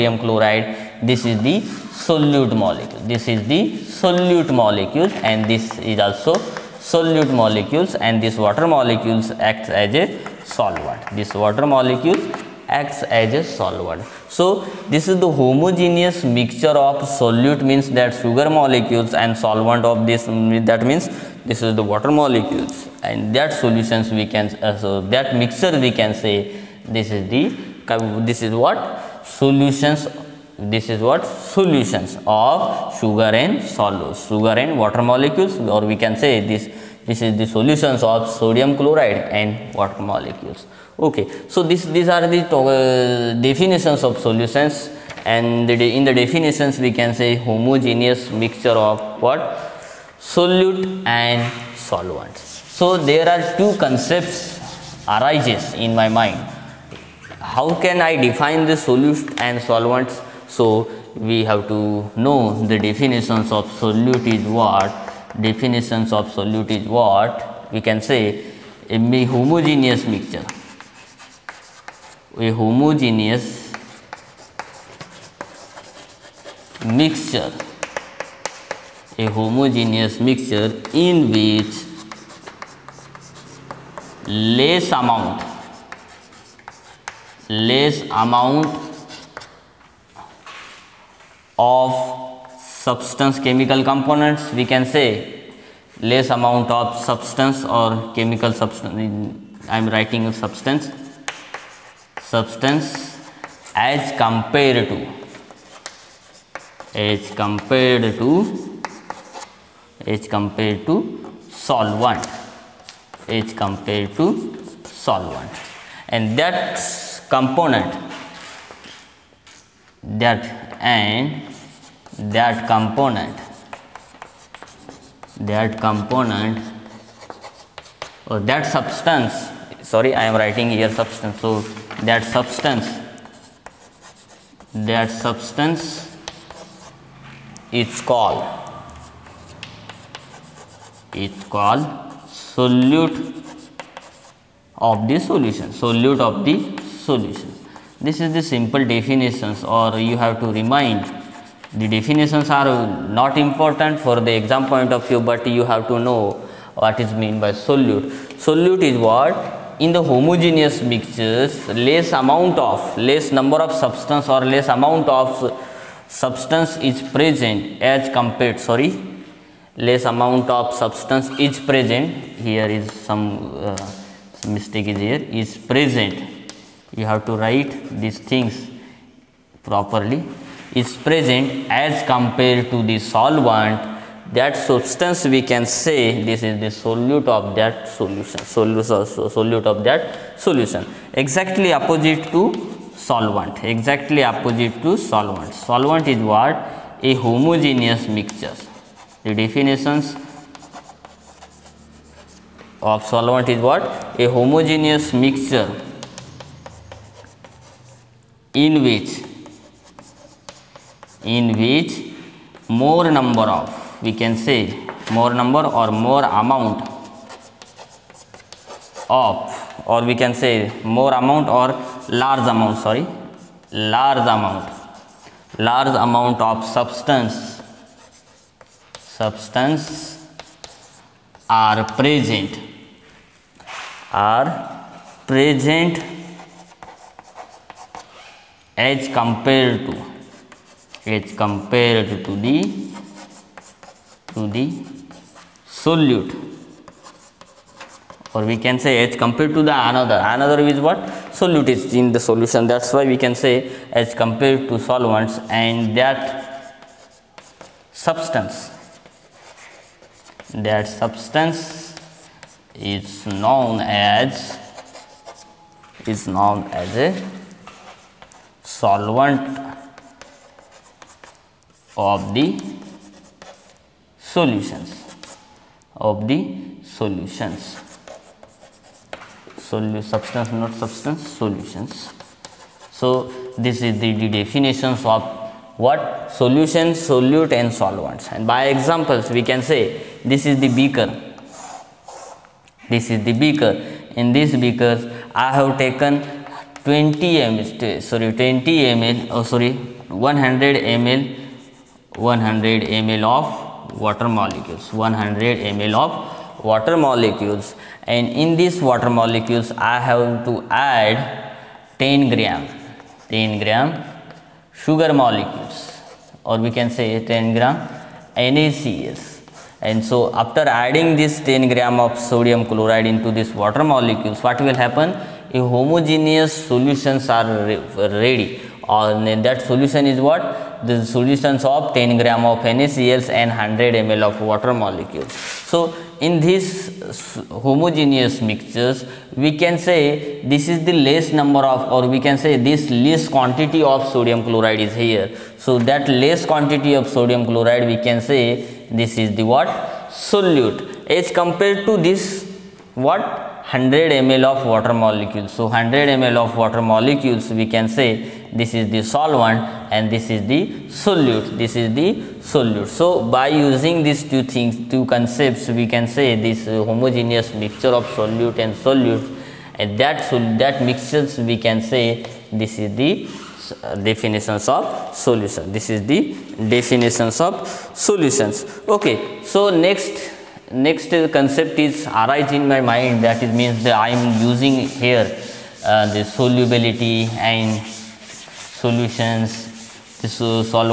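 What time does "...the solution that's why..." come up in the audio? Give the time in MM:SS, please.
04:12.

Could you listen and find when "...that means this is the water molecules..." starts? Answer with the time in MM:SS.
00:20.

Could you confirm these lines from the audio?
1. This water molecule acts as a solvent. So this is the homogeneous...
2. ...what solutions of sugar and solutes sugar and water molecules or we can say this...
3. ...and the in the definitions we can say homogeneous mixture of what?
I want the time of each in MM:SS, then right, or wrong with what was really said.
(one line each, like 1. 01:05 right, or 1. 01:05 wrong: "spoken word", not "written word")
1. 00:11 right
2. 00:31 right
3. 00:45 right.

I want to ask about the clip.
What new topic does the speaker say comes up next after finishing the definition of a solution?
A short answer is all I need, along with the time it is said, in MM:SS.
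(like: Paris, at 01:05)
Solubility, at 06:26.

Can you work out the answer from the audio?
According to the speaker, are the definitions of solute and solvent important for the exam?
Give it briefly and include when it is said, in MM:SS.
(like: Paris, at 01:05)
Not important, at 02:32.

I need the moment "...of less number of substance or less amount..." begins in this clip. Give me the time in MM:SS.
02:42.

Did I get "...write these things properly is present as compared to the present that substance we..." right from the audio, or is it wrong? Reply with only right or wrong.
wrong.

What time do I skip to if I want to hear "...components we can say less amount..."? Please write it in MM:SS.
01:33.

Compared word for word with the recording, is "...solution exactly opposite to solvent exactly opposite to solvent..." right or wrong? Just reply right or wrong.
right.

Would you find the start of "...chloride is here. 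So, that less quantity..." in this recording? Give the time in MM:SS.
05:44.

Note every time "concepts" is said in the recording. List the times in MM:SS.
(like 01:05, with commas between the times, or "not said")
00:53, 06:05, 06:21.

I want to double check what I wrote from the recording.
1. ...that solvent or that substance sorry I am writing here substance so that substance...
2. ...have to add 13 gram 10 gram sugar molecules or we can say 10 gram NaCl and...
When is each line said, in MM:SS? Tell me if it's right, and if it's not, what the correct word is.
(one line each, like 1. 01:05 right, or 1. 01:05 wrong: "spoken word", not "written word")
1. 02:05 wrong: "component", not "solvent"
2. 05:10 wrong: "10", not "13".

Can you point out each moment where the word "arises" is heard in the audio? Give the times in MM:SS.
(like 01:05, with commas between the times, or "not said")
00:55, 06:22.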